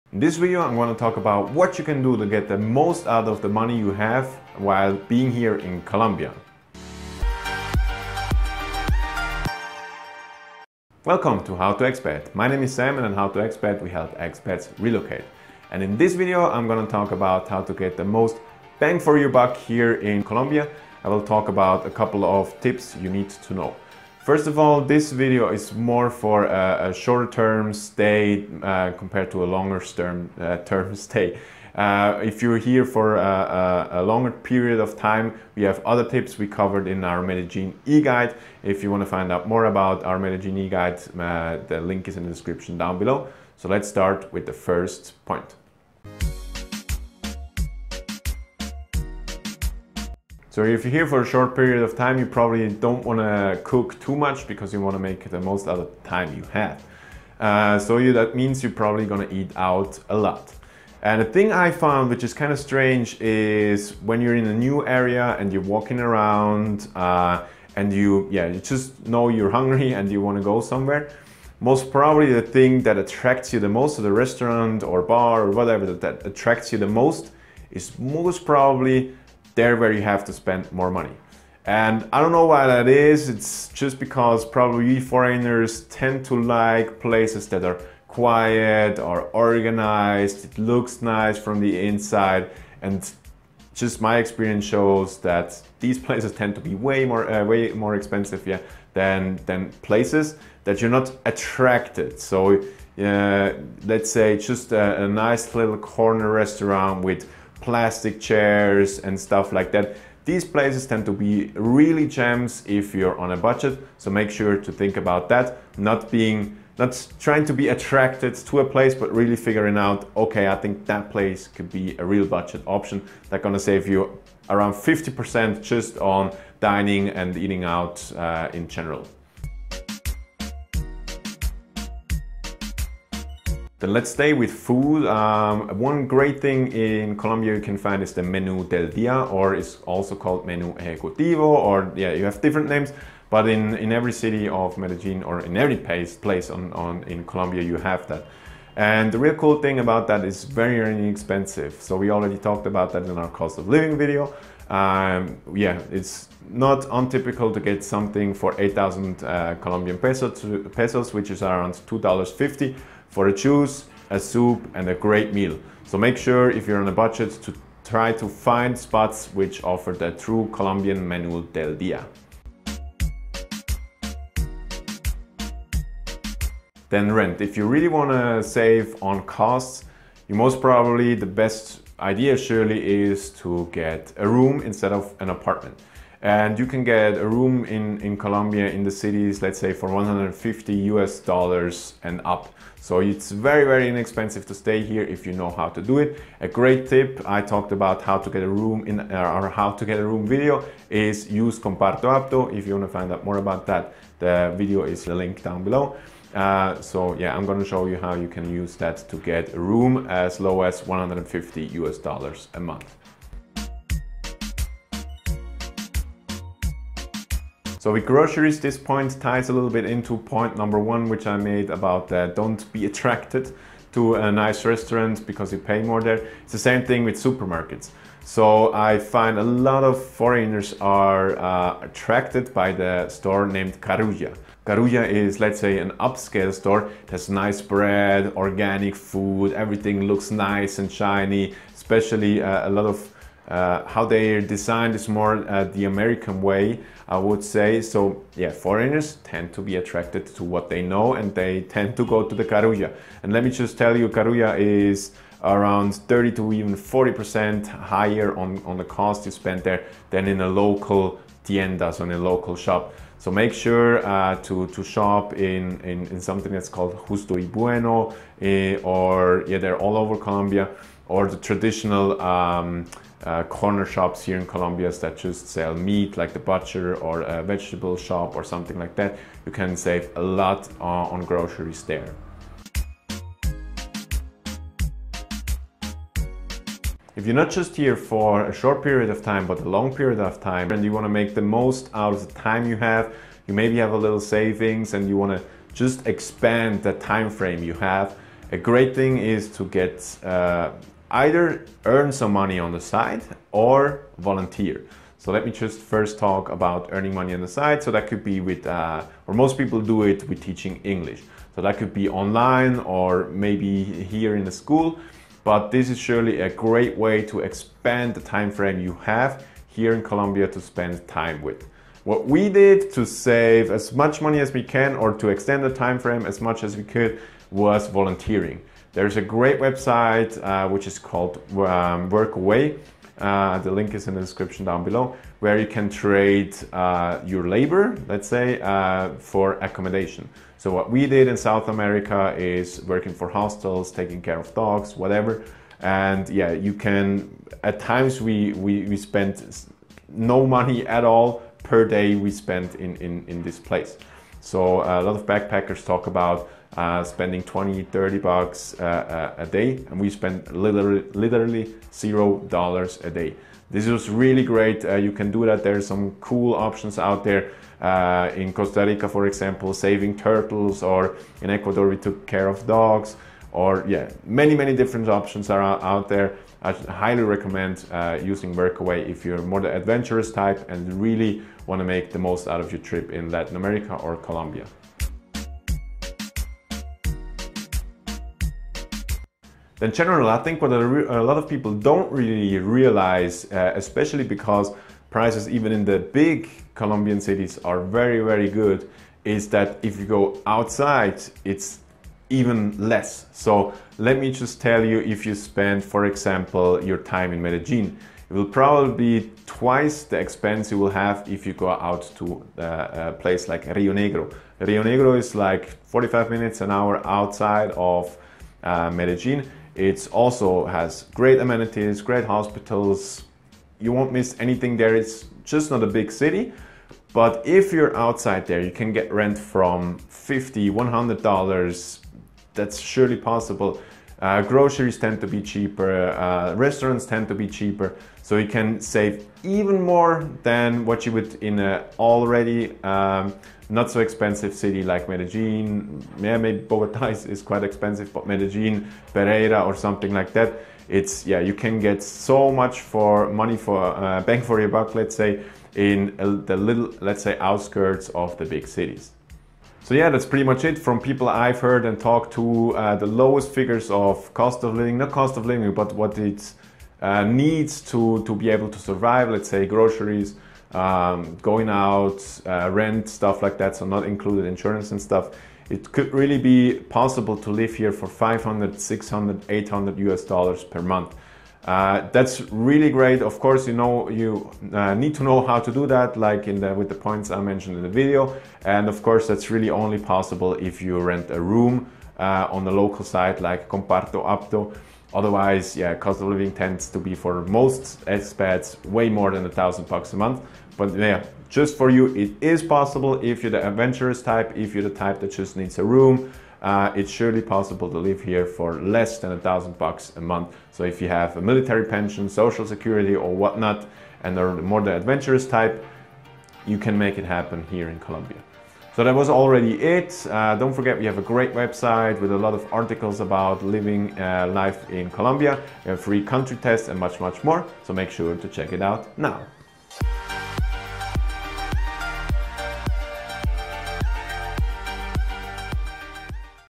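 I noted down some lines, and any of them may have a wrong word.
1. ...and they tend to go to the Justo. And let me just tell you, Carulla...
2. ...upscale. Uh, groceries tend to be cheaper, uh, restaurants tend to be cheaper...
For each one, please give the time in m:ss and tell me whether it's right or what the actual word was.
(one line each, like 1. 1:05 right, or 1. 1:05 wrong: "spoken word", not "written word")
1. 4:11 wrong: "Carulla", not "Justo"
2. 7:13 wrong: "possible", not "upscale".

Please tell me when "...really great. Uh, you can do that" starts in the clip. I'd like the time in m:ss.
6:04.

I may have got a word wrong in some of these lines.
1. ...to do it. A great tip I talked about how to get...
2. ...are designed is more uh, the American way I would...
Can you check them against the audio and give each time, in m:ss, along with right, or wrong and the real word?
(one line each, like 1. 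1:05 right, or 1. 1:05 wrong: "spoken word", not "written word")
1. 3:15 right
2. 4:04 right.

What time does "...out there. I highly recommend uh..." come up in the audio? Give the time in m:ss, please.
6:15.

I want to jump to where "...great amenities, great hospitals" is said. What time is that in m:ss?
7:01.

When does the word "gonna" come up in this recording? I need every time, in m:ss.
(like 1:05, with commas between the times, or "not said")
2:03, 3:27.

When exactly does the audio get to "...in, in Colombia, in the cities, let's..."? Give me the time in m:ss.
3:07.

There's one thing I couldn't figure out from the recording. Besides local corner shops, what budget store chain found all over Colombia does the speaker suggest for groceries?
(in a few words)
Justo y Bueno.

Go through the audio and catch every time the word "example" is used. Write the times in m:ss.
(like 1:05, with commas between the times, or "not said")
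6:09, 6:46.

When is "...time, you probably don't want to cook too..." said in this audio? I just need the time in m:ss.
0:51.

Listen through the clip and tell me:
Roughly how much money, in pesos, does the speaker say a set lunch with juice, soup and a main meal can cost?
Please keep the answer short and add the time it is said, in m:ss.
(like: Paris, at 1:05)
8,000 pesos, at 2:38.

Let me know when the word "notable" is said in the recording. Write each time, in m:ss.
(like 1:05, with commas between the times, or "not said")
not said.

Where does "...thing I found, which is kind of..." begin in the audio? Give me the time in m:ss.
1:01.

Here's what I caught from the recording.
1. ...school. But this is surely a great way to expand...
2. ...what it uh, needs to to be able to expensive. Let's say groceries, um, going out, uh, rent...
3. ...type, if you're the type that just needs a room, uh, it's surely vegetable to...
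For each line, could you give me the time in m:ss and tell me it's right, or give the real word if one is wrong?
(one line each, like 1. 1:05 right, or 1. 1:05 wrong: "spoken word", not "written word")
1. 5:14 right
2. 7:45 wrong: "survive", not "expensive"
3. 8:24 wrong: "possible", not "vegetable".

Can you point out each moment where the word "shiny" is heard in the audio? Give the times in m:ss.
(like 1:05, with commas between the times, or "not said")
4:00.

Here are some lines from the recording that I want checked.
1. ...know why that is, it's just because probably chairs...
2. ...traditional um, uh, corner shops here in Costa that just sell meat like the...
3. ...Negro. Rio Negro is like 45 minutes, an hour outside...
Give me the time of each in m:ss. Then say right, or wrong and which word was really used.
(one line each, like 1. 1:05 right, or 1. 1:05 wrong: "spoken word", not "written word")
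1. 1:22 wrong: "foreigners", not "chairs"
2. 4:31 wrong: "Colombia", not "Costa"
3. 6:53 right.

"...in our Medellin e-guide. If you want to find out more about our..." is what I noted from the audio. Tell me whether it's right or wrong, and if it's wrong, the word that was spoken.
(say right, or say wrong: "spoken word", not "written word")
right.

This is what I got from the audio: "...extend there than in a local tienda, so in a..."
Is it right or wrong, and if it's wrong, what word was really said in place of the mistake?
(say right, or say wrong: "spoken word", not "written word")
wrong: "spend", not "extend".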